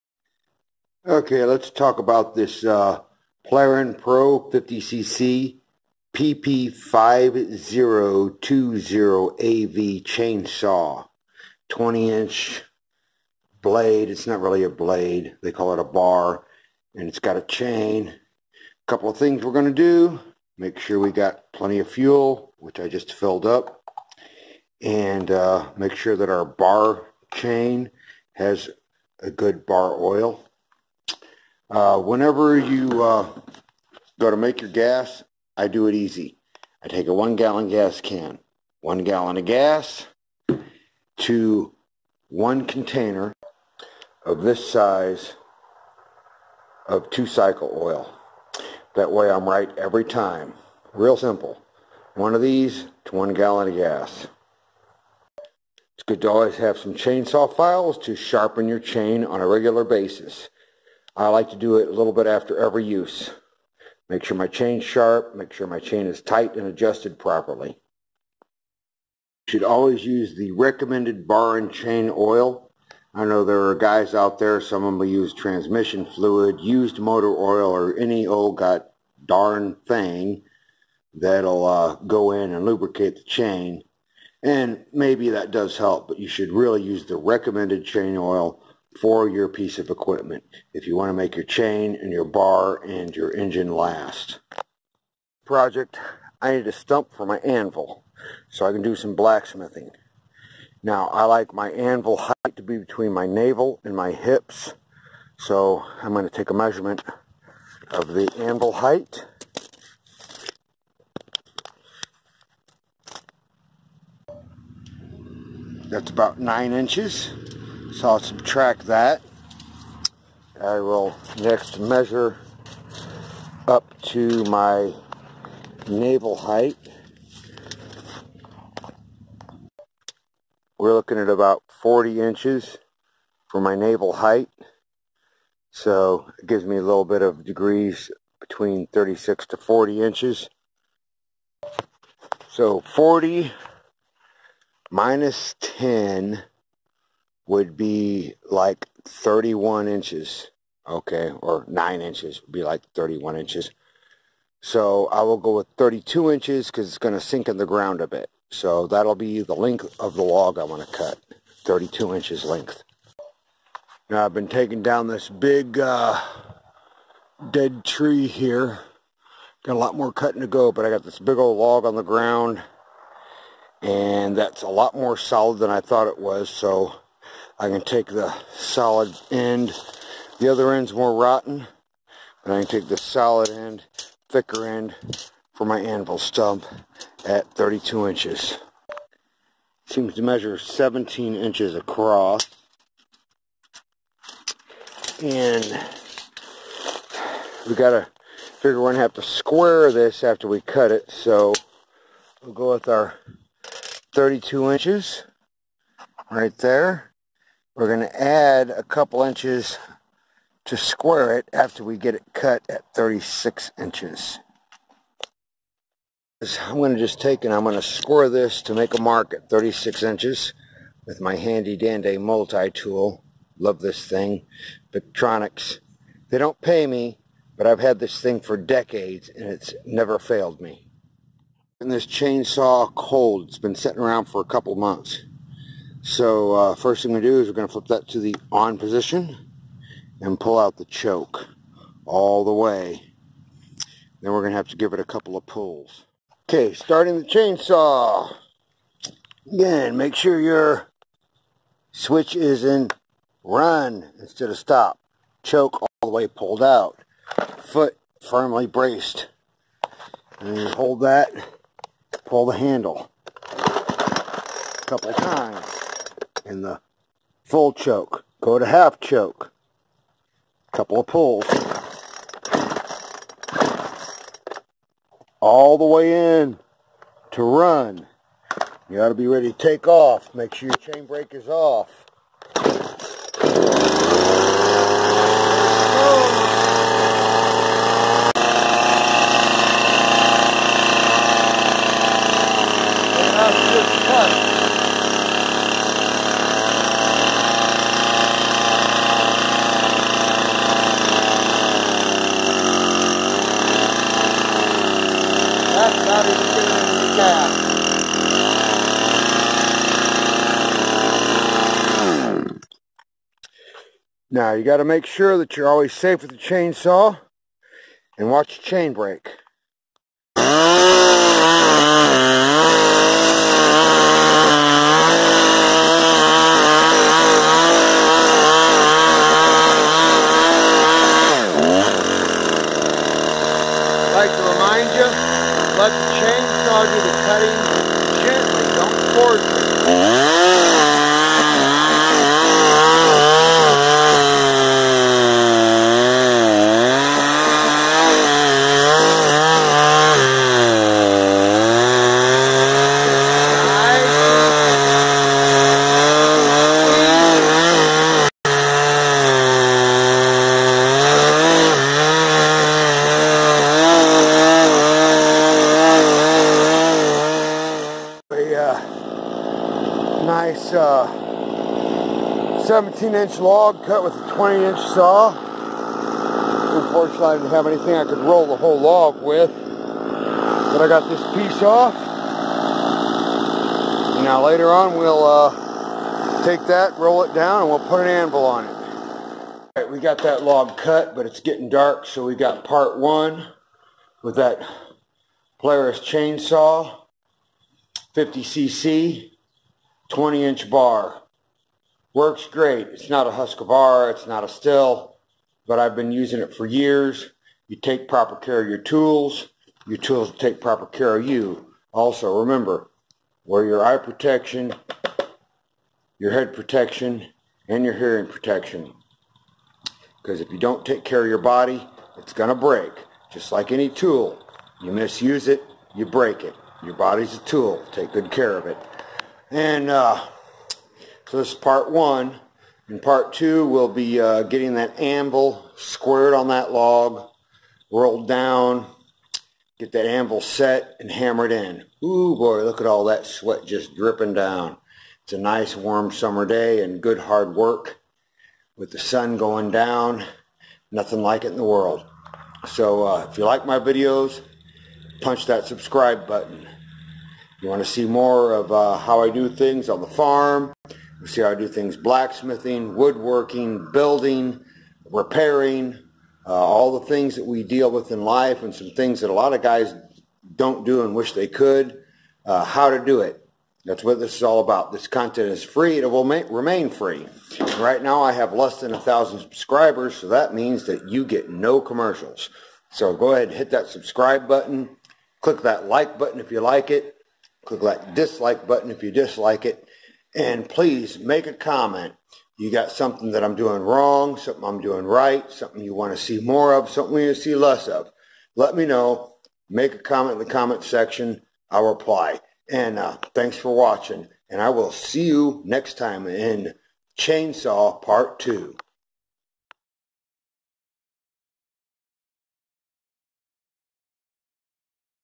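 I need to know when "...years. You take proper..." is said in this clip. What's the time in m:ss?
6:46.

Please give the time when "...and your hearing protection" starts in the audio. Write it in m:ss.
6:57.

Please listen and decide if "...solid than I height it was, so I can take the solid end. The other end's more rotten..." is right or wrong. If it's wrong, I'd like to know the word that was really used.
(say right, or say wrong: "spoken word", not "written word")
wrong: "thought", not "height".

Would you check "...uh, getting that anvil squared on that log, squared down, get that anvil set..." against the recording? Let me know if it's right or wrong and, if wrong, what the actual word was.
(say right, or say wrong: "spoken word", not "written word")
wrong: "rolled", not "squared".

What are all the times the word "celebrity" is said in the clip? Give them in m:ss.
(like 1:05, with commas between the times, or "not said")
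not said.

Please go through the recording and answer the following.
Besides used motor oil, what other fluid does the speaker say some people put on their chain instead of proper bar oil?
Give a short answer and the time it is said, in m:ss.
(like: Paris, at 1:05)
transmission fluid, at 1:15.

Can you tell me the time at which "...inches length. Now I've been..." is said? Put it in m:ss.
2:42.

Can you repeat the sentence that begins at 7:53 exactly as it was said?
That's what this is all about.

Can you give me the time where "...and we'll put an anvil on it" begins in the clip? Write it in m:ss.
6:27.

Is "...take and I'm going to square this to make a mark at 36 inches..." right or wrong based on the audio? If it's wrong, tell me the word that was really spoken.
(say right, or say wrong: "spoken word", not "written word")
right.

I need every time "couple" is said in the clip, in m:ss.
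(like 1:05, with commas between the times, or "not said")
0:18, 3:28, 3:54, 4:05, 4:24, 4:30.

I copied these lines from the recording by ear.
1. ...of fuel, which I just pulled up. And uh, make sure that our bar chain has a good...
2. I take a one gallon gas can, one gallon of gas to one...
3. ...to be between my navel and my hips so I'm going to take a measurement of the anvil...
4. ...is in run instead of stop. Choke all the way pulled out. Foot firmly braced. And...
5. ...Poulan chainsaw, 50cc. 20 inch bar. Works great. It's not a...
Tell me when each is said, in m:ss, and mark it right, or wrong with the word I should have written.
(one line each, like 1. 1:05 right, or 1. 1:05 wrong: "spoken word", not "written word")
1. 0:21 wrong: "filled", not "pulled"
2. 0:36 right
3. 1:42 right
4. 4:12 right
5. 6:35 right.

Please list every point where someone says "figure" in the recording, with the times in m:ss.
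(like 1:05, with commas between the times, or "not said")
3:18.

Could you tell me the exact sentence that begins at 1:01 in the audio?
I like to do it a little bit after every use.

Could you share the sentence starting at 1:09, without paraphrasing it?
You should always use the recommended bar and chain oil.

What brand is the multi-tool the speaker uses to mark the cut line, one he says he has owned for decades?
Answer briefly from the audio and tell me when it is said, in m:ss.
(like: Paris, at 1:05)
Victorinox, at 3:44.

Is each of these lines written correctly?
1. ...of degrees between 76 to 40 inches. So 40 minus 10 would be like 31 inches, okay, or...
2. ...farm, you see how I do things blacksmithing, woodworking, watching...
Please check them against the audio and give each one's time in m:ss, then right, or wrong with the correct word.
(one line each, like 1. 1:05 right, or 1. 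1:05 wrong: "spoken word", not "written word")
1. 2:17 wrong: "36", not "76"
2. 7:40 wrong: "building", not "watching".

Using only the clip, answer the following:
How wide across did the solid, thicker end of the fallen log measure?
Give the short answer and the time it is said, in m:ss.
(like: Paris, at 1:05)
17 inches, at 3:10.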